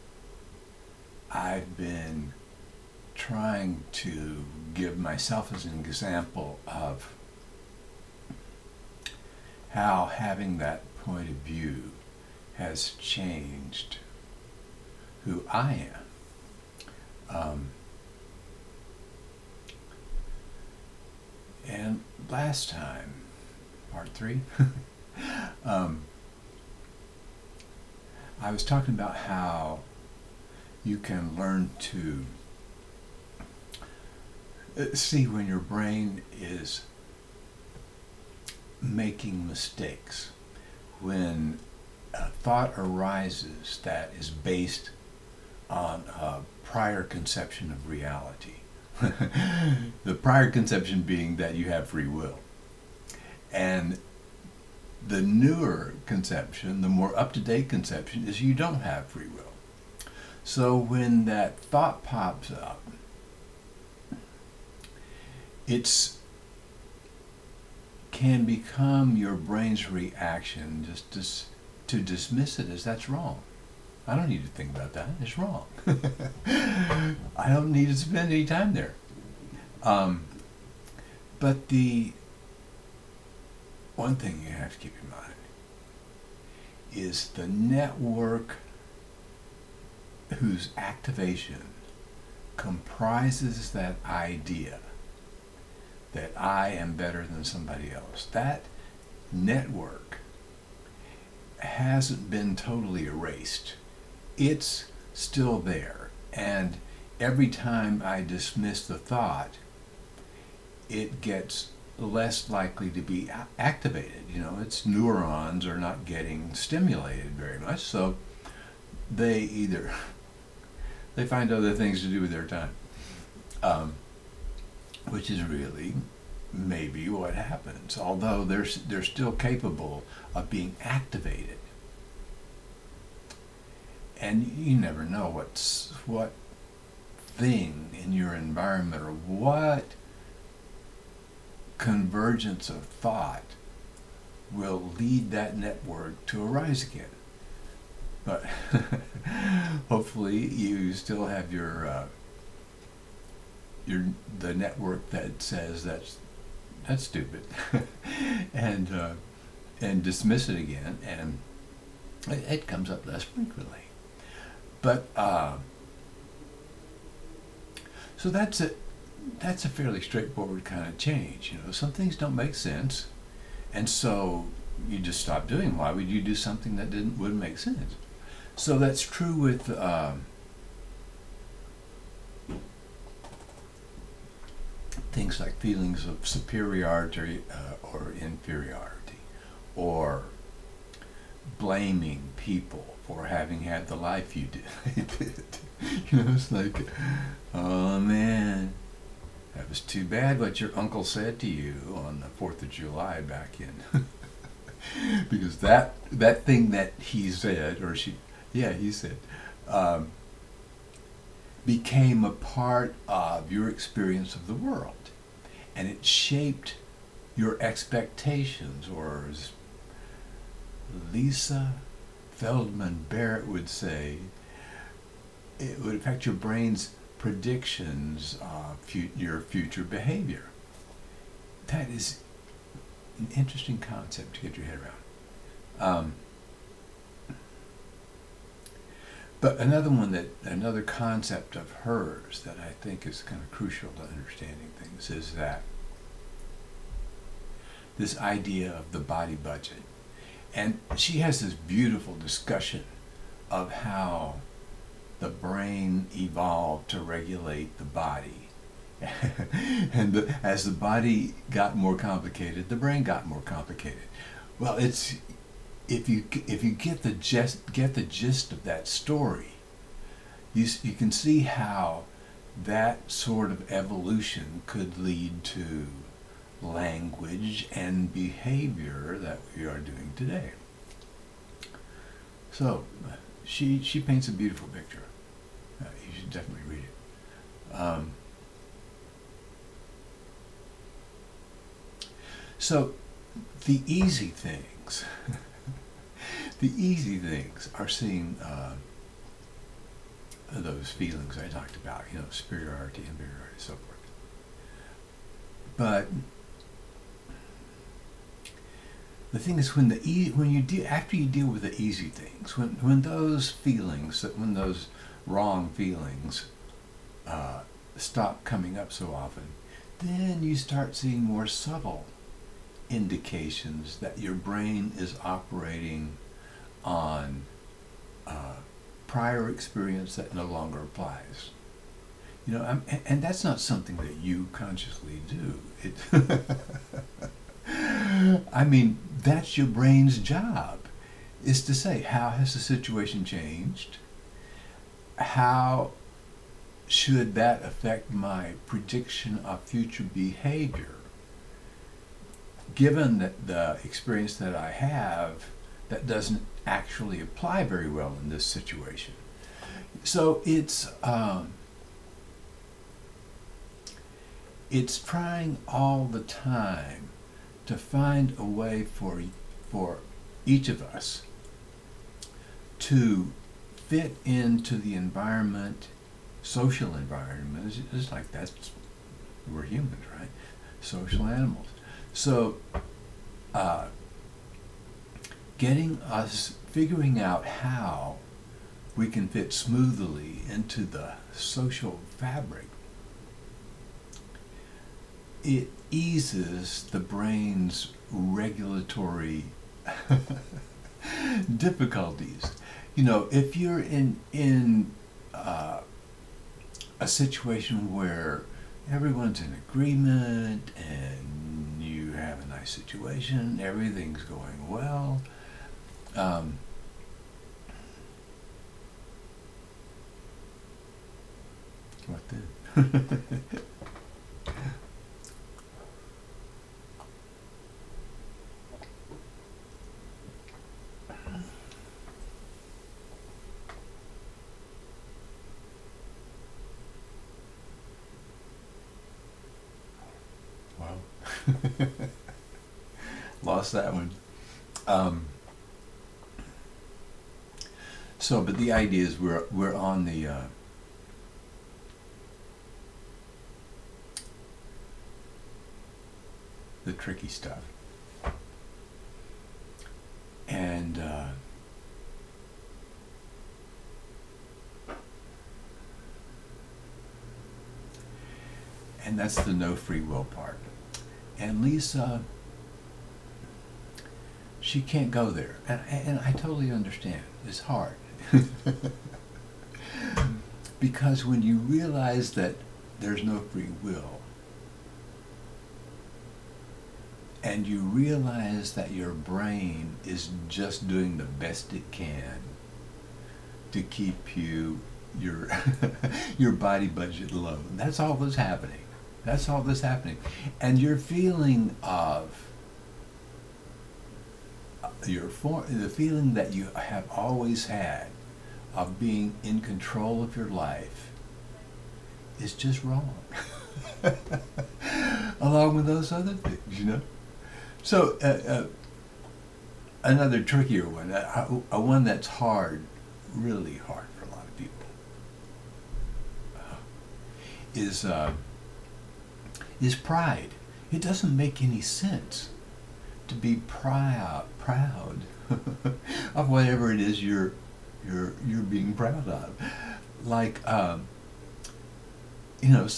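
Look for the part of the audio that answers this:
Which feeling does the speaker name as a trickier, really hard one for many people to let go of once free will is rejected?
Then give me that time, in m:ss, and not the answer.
8:49.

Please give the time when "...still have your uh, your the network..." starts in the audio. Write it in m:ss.
2:30.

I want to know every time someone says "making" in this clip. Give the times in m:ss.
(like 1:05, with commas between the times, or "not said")
0:38.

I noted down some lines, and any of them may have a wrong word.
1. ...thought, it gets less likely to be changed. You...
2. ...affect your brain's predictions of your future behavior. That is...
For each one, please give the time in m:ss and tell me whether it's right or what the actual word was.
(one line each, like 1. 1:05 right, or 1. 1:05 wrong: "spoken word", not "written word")
1. 1:48 wrong: "activated", not "changed"
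2. 3:45 right.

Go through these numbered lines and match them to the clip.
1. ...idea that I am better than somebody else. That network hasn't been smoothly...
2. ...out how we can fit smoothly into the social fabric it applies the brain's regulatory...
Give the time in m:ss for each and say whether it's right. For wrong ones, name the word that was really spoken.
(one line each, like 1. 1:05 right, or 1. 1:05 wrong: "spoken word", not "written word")
1. 1:34 wrong: "totally", not "smoothly"
2. 6:27 wrong: "eases", not "applies".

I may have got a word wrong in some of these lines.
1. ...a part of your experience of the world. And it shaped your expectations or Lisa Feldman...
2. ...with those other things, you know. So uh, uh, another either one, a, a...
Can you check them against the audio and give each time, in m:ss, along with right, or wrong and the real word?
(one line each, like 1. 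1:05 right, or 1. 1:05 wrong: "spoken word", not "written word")
1. 3:32 right
2. 8:35 wrong: "trickier", not "either".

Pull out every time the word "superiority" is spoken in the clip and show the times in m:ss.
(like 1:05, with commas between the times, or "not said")
3:06, 5:02.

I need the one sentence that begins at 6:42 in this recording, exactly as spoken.
You know, if you're in in uh, a situation where everyone's in agreement and you have a nice situation, everything's going well.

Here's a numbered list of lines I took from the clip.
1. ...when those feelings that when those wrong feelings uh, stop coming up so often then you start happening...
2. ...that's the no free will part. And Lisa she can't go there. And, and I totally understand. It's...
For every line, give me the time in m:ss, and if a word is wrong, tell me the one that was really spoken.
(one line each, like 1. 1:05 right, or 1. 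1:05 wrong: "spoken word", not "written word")
1. 5:12 wrong: "seeing", not "happening"
2. 7:49 right.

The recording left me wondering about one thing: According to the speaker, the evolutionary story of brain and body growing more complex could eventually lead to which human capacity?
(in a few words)
Language.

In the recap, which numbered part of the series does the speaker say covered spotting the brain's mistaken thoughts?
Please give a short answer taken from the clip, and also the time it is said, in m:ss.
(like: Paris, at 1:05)
Part three, at 0:23.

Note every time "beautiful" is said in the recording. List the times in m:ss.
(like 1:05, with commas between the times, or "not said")
4:11, 4:44.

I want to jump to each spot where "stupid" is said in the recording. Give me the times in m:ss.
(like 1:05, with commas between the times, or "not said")
2:37.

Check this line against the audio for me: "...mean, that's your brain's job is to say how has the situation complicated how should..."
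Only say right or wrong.
wrong.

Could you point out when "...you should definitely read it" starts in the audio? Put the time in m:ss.
4:46.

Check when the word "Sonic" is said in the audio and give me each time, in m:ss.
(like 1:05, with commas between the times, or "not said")
not said.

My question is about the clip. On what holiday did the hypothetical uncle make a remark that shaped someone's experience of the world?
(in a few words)
The 4th of July.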